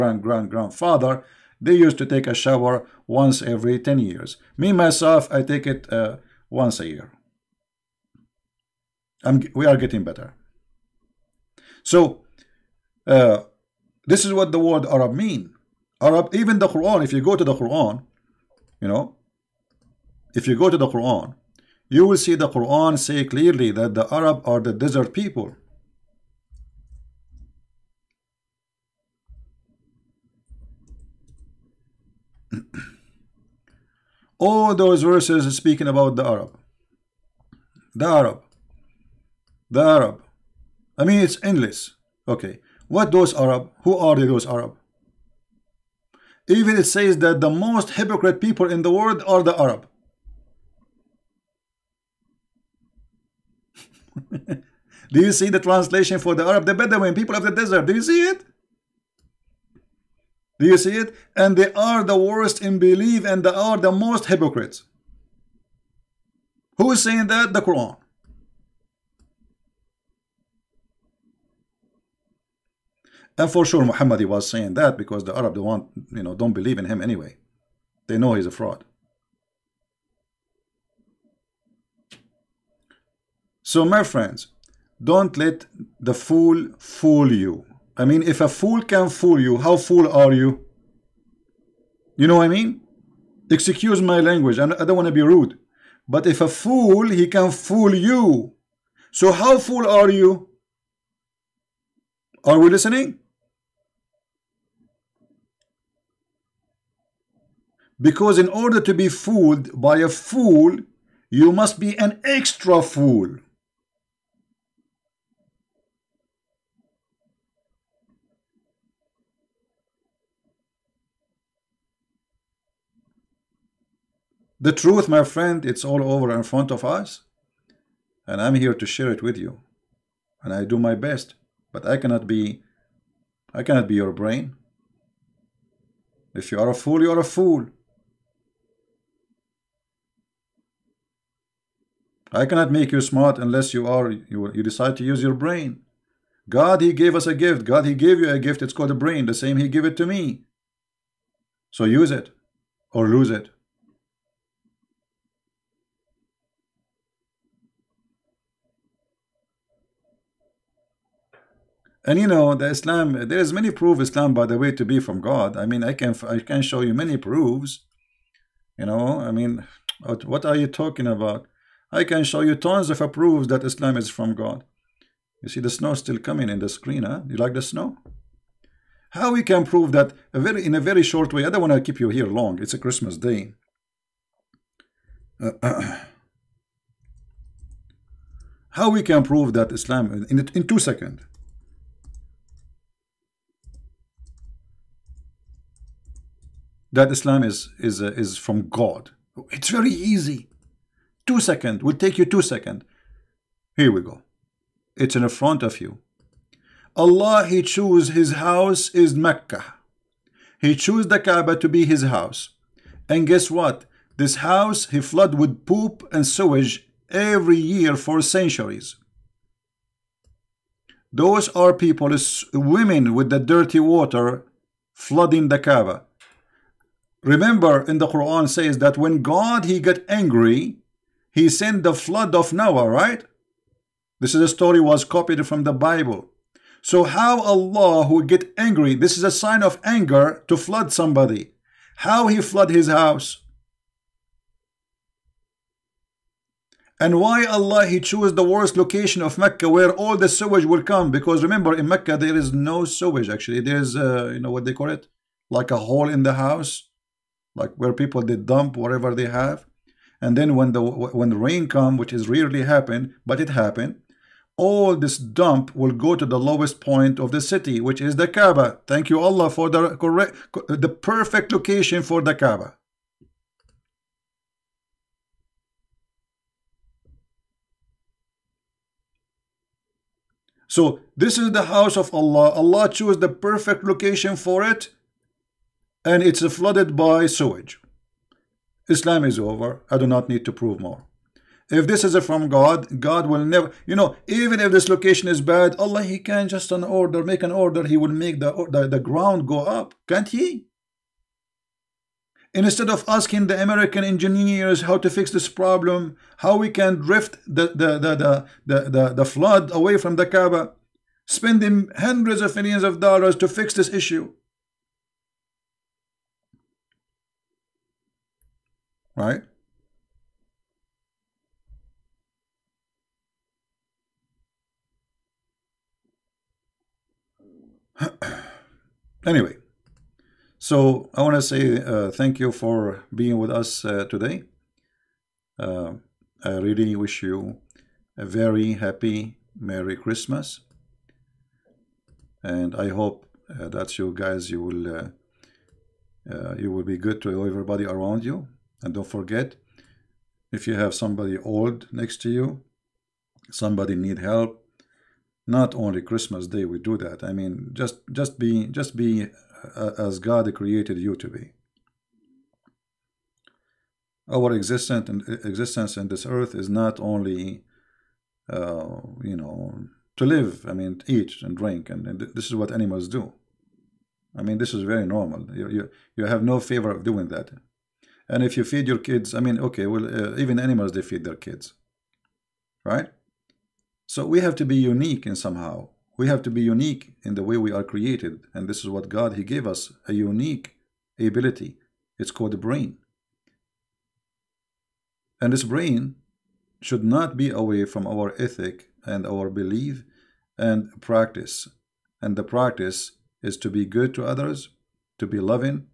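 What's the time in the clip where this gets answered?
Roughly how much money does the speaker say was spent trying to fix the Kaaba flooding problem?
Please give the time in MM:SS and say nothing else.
05:11.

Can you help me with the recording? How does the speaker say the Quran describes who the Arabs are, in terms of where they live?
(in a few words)
The desert people.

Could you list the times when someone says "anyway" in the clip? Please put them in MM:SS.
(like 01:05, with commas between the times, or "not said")
01:17, 05:29.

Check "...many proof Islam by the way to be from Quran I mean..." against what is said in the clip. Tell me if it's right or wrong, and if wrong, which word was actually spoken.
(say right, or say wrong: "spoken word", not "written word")
wrong: "God", not "Quran".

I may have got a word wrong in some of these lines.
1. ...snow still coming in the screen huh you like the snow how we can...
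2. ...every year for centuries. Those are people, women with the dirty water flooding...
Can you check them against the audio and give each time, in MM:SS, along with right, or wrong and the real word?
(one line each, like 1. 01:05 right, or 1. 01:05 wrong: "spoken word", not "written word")
1. 02:55 right
2. 03:37 right.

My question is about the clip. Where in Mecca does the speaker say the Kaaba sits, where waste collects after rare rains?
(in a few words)
The lowest point of the city.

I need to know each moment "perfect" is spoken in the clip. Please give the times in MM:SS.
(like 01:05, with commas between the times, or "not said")
04:30, 04:43.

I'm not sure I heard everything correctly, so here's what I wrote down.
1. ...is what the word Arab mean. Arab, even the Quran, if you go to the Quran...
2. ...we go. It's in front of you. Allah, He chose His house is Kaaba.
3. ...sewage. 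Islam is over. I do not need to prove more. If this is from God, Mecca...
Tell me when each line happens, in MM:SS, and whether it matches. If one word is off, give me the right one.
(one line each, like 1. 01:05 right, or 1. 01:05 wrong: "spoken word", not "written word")
1. 00:14 right
2. 03:23 wrong: "Mecca", not "Kaaba"
3. 04:47 wrong: "God", not "Mecca".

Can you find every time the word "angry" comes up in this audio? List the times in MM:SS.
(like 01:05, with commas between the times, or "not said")
03:50, 03:58.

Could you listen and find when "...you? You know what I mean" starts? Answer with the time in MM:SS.
01:30.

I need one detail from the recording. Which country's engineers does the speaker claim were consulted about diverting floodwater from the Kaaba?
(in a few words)
American engineers.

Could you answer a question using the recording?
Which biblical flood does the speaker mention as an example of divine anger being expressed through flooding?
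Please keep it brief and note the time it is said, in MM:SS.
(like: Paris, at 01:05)
The flood of Noah, at 03:51.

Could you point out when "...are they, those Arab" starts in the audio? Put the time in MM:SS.
00:43.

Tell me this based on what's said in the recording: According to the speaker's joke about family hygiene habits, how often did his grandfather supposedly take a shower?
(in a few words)
Once every 10 years.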